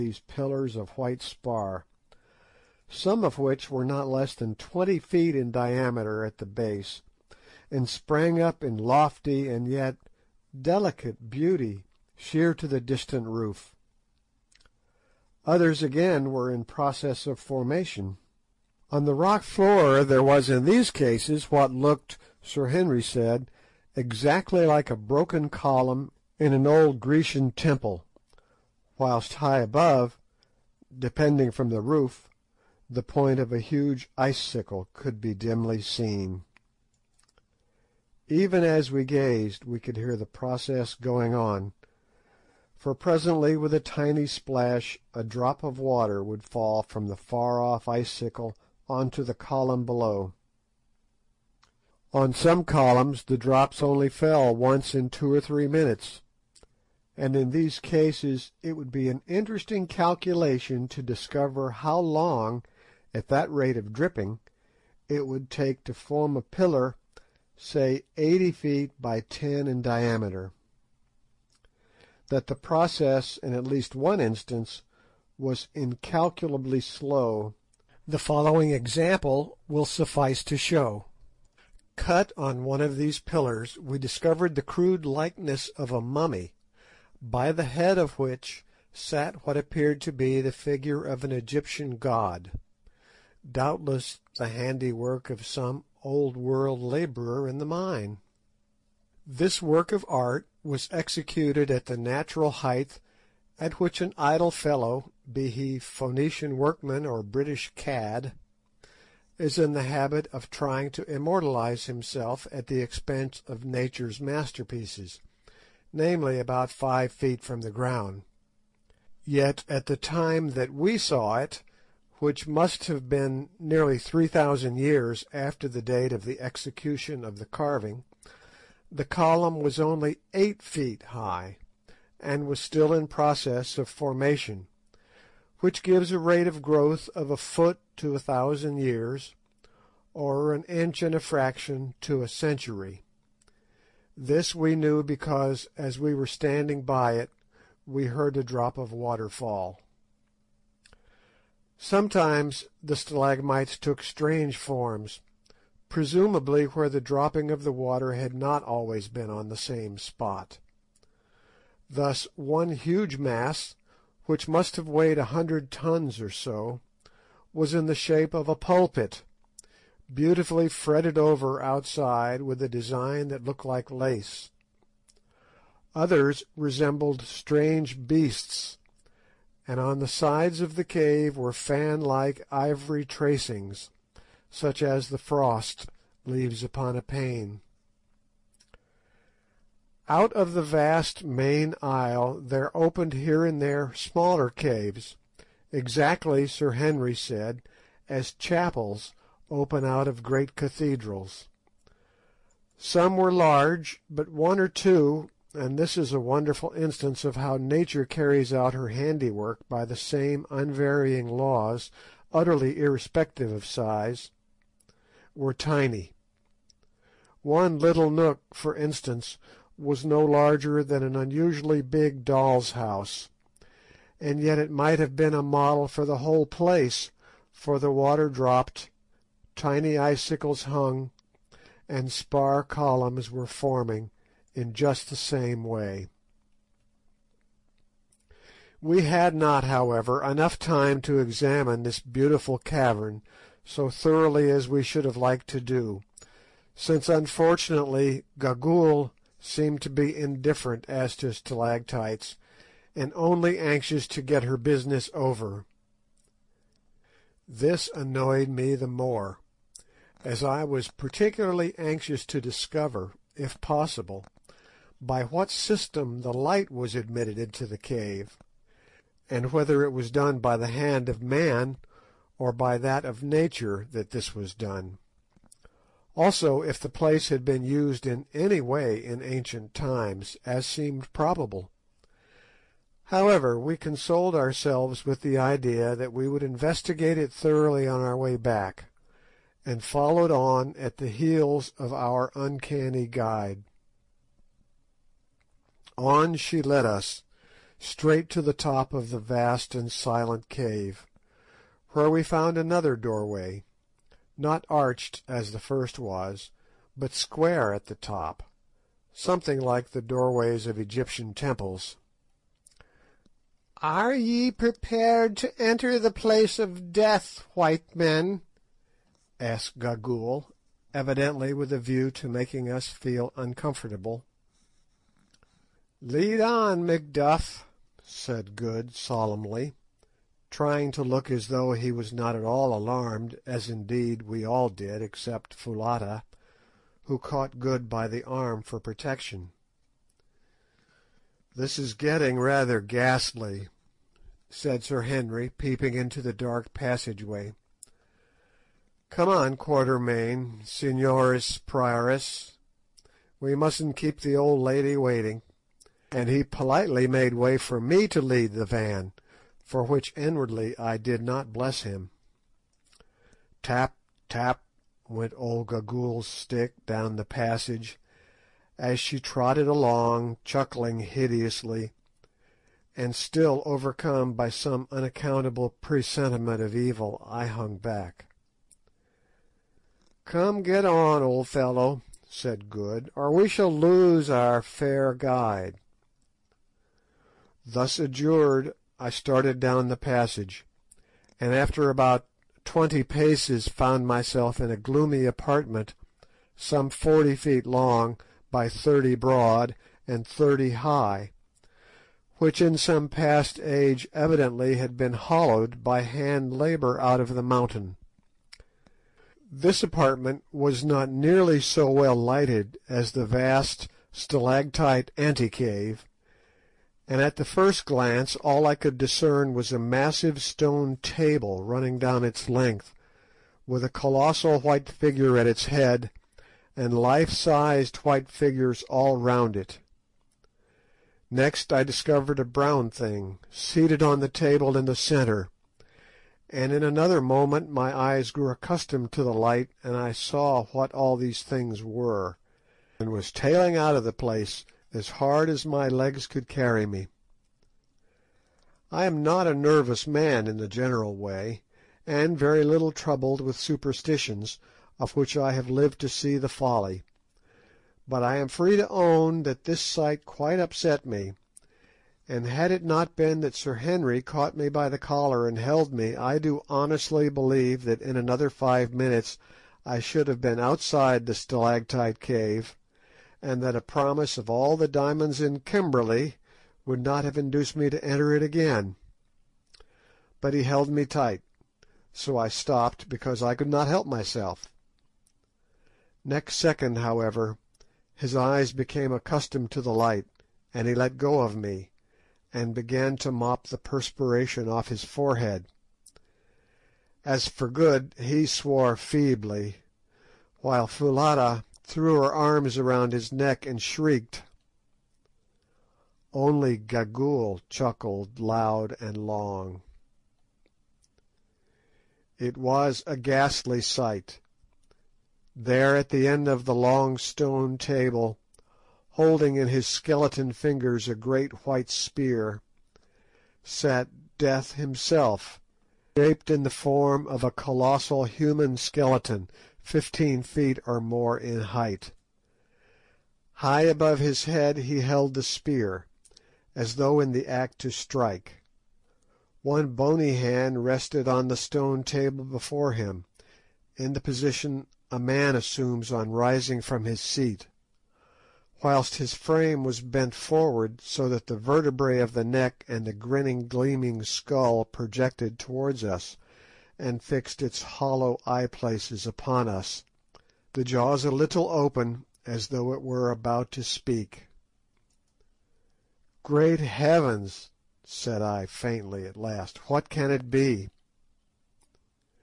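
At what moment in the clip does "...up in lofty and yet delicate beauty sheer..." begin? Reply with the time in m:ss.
0:08.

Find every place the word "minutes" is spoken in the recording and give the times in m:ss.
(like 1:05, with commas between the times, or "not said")
0:55, 7:48.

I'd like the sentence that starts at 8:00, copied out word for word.
But he held me tight, so I stopped because I could not help myself.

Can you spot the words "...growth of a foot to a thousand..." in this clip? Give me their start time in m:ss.
2:16.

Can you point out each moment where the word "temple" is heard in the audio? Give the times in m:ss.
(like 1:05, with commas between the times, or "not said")
0:27, 5:11.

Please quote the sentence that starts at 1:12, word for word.
That the process, in at least one instance, was incalculably slow, the following example will suffice to show.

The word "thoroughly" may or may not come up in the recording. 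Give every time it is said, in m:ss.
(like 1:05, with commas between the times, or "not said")
4:03, 4:47.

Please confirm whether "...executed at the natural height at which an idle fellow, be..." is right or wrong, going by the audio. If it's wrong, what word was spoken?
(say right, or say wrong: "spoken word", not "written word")
right.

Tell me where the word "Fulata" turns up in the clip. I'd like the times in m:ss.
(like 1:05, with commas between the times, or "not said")
5:35, 8:20.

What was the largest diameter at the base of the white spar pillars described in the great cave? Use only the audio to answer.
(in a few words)
20 feet.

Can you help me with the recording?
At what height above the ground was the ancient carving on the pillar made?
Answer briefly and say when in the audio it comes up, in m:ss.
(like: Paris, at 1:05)
about 5 feet, at 1:56.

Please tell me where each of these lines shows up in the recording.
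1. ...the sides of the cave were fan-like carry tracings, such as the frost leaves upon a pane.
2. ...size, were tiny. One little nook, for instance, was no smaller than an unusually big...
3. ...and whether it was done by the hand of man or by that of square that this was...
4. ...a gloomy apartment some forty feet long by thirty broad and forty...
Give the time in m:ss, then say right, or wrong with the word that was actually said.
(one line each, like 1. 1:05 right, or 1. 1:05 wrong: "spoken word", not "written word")
1. 2:59 wrong: "ivory", not "carry"
2. 3:33 wrong: "larger", not "smaller"
3. 4:29 wrong: "nature", not "square"
4. 6:34 wrong: "thirty", not "forty".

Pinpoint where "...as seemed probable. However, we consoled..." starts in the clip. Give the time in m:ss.
4:40.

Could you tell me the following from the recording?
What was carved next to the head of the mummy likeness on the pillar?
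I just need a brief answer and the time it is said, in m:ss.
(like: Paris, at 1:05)
an Egyptian god, at 1:31.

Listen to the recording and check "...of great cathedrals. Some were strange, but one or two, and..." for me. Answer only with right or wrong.
wrong.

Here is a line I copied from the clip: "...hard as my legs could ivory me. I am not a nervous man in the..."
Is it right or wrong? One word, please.
wrong.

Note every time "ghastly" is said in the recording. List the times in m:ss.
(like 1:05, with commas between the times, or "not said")
5:42, 8:33.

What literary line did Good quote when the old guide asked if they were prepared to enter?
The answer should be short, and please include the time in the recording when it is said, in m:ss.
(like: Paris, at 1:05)
Lead on, Macduff, at 5:26.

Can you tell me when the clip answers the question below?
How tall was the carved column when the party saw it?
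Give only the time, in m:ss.
2:10.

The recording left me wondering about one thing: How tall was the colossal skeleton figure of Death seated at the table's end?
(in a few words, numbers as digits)
15 feet or more.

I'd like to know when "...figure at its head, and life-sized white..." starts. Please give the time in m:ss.
7:04.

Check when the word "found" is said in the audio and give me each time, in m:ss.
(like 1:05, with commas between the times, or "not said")
5:02, 6:33.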